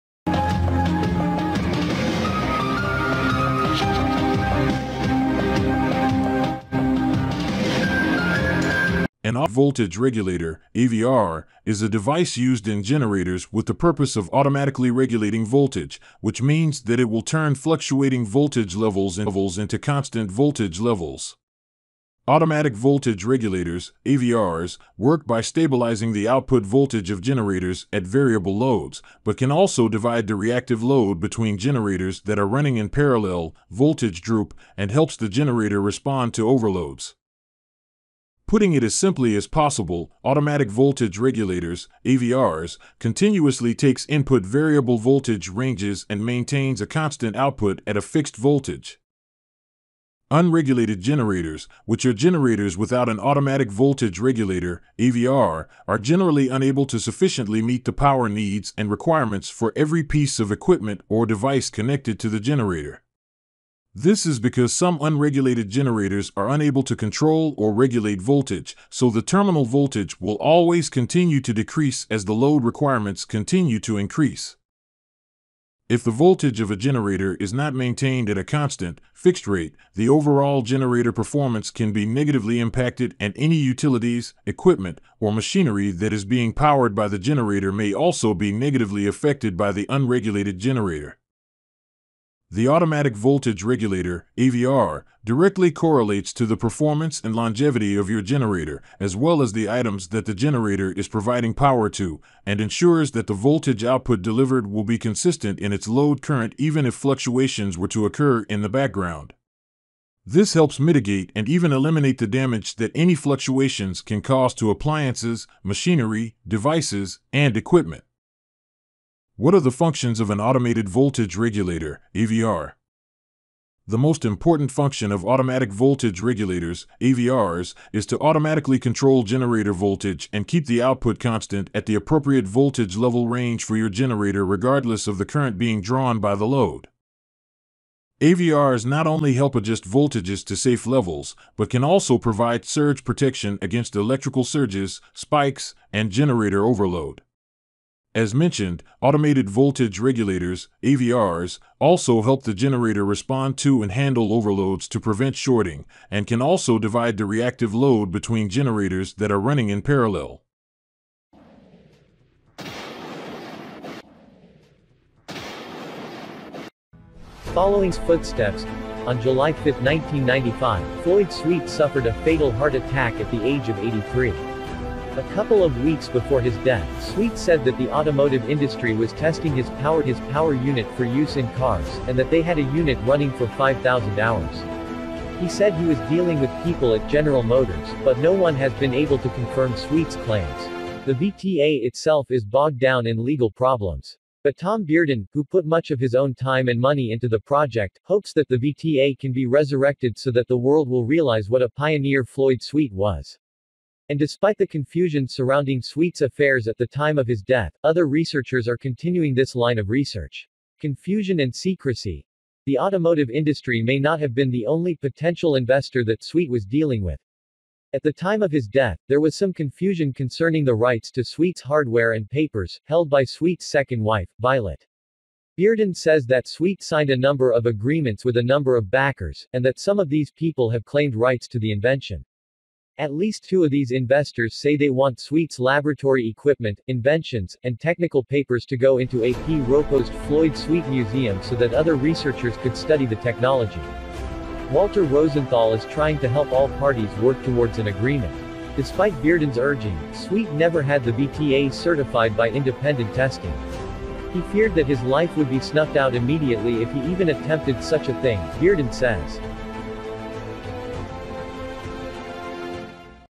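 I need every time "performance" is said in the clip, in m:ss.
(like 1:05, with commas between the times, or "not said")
1:21, 1:36.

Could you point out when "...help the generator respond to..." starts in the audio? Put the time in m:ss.
2:32.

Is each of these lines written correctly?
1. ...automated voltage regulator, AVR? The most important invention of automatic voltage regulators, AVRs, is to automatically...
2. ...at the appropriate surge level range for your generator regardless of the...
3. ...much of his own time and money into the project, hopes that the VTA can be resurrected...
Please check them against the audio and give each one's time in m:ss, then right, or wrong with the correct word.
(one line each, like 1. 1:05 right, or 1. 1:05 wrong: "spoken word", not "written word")
1. 2:00 wrong: "function", not "invention"
2. 2:11 wrong: "voltage", not "surge"
3. 3:15 right.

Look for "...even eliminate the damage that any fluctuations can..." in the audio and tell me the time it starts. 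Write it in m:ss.
1:51.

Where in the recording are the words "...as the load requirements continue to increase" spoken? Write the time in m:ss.
1:12.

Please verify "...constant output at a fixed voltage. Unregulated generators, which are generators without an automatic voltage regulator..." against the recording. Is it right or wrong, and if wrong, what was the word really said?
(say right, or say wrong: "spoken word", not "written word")
right.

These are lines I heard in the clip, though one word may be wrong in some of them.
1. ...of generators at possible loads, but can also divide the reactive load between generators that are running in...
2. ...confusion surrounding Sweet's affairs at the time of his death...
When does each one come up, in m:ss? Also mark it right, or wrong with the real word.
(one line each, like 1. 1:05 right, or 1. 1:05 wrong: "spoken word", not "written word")
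1. 0:27 wrong: "variable", not "possible"
2. 3:24 right.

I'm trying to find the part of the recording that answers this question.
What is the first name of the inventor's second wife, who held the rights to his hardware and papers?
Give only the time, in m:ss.
3:44.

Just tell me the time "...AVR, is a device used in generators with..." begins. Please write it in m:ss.
0:10.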